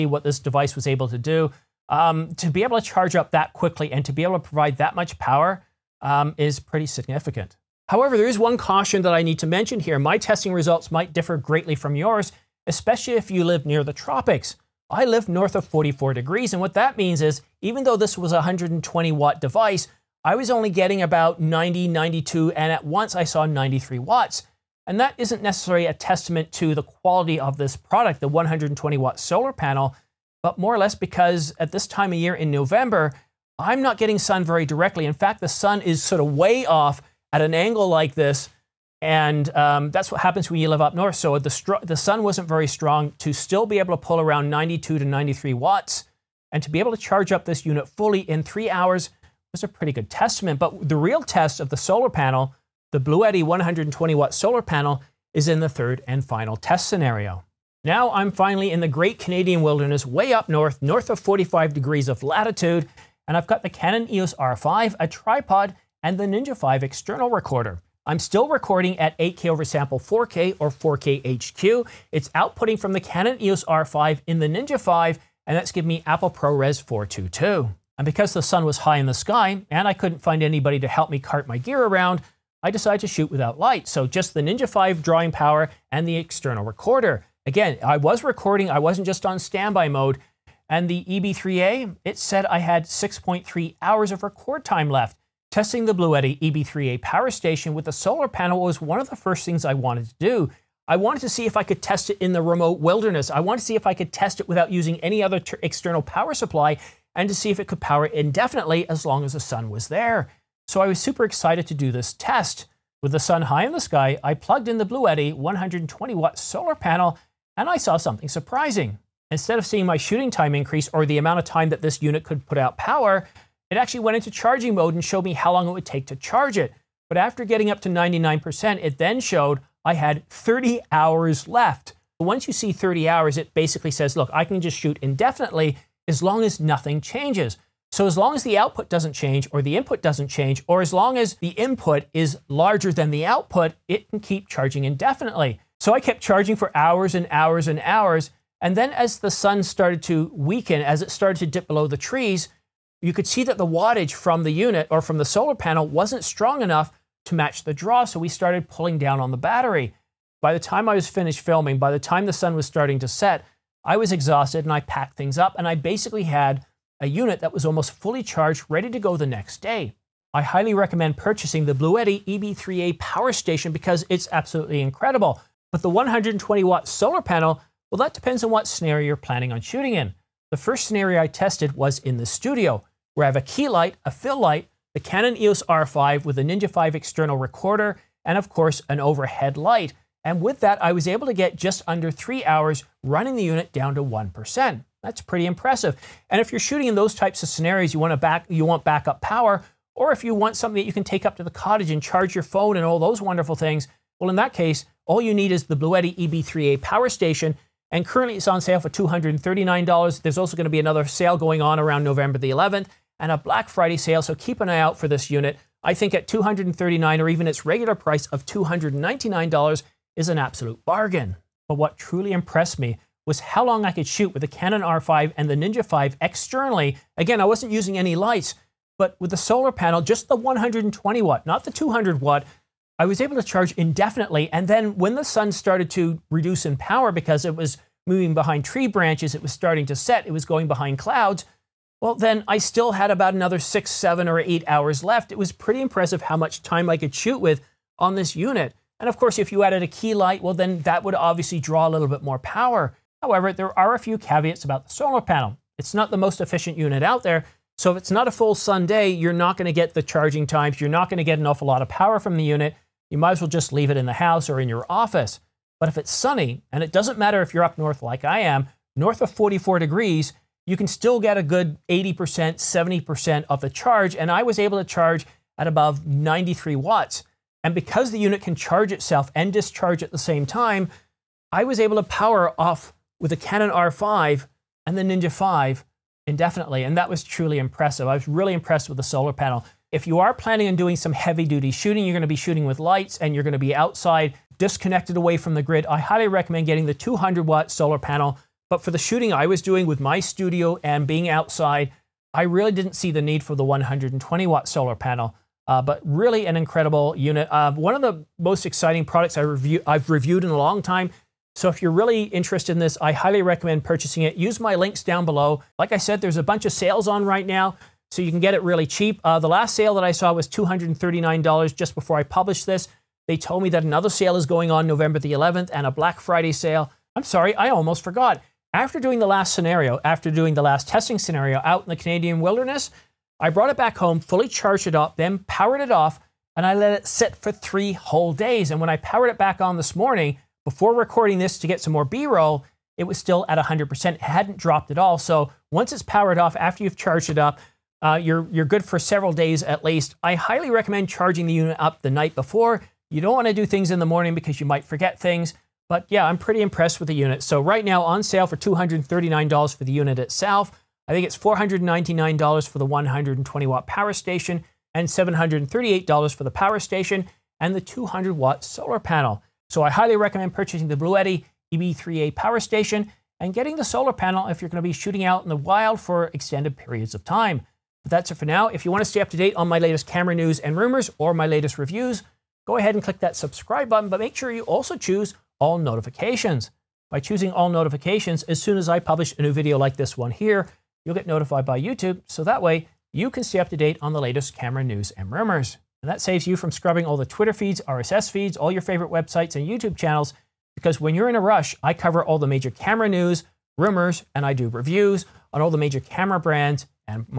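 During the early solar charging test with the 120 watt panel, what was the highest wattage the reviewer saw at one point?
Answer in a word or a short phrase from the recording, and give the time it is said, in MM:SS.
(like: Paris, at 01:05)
93 watts, at 00:22.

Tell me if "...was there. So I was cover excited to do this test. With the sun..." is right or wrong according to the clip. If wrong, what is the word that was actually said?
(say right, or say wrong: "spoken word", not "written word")
wrong: "super", not "cover".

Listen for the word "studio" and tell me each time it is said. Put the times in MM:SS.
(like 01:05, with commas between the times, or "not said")
03:02, 05:00.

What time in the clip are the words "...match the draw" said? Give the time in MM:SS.
02:37.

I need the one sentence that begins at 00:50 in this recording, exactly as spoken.
But the real test of the solar panel, the Bluetti 120 watt solar panel, is in the third and final test scenario.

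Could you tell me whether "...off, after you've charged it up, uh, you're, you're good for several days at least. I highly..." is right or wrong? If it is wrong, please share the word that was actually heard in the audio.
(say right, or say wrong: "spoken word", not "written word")
right.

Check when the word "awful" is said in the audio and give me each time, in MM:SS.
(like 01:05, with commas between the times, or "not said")
04:21.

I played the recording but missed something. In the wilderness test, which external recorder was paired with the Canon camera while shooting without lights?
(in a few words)
Ninja 5.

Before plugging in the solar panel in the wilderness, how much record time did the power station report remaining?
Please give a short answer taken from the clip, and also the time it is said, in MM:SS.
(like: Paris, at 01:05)
6.3 hours, at 01:32.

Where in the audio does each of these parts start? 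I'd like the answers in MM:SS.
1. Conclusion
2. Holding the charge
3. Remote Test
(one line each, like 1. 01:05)
1. 02:49
2. 05:25
3. 00:57.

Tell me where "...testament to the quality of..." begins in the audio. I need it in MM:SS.
00:25.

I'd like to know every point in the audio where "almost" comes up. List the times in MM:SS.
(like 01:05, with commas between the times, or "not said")
02:47, 05:27.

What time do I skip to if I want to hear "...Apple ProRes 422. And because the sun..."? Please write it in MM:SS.
01:16.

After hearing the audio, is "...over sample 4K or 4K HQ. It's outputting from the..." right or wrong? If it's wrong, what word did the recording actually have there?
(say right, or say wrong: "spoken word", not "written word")
right.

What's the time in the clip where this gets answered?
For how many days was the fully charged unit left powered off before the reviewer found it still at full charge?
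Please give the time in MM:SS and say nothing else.
05:37.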